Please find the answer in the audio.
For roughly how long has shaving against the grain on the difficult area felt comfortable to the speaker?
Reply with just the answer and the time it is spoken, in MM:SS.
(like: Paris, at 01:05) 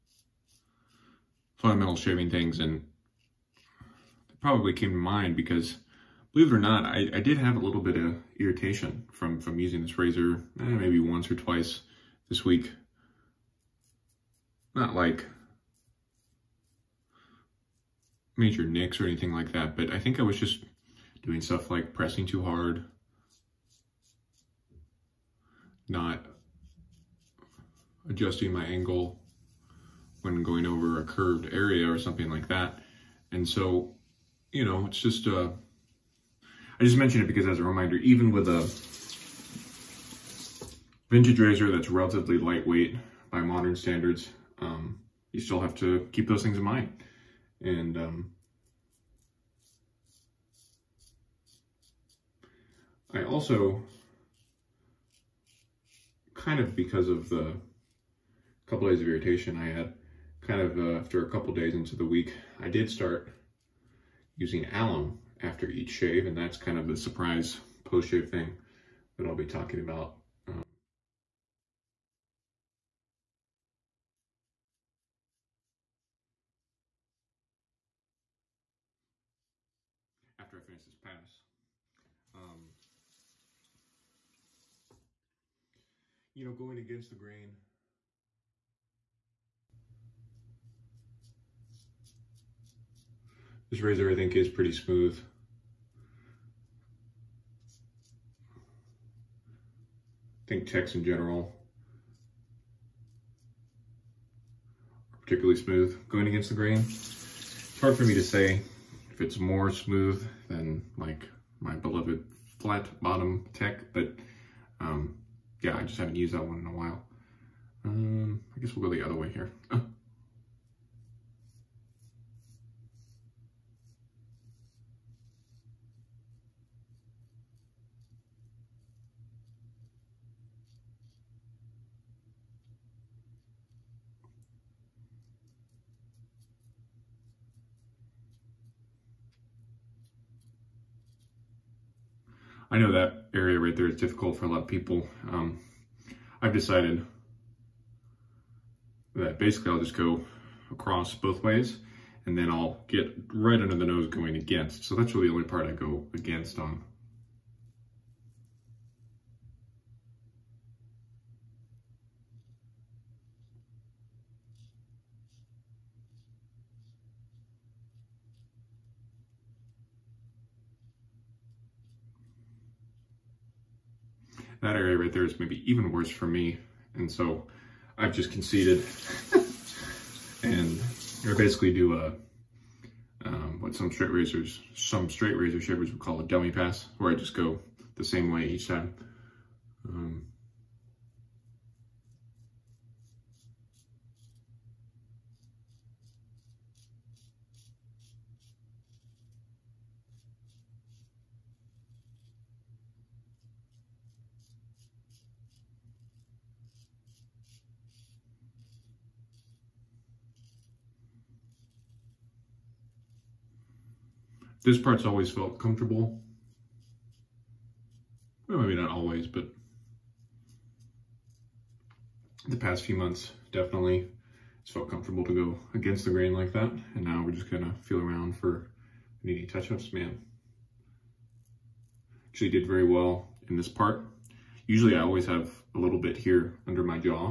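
the past few months, at 03:42.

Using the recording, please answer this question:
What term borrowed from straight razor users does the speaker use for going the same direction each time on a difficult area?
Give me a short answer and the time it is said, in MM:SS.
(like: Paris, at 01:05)
dummy pass, at 03:06.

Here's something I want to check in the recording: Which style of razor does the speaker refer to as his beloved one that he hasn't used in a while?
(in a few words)
flat bottom tech.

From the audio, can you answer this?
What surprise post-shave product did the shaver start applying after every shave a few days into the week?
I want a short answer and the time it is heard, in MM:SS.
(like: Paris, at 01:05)
alum, at 01:04.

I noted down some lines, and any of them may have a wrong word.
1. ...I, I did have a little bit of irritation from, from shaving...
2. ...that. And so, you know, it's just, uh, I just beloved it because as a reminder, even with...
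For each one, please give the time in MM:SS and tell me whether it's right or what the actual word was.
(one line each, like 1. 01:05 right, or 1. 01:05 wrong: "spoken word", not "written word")
1. 00:06 wrong: "using", not "shaving"
2. 00:32 wrong: "mentioned", not "beloved".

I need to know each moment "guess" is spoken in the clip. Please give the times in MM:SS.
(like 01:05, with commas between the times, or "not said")
01:58.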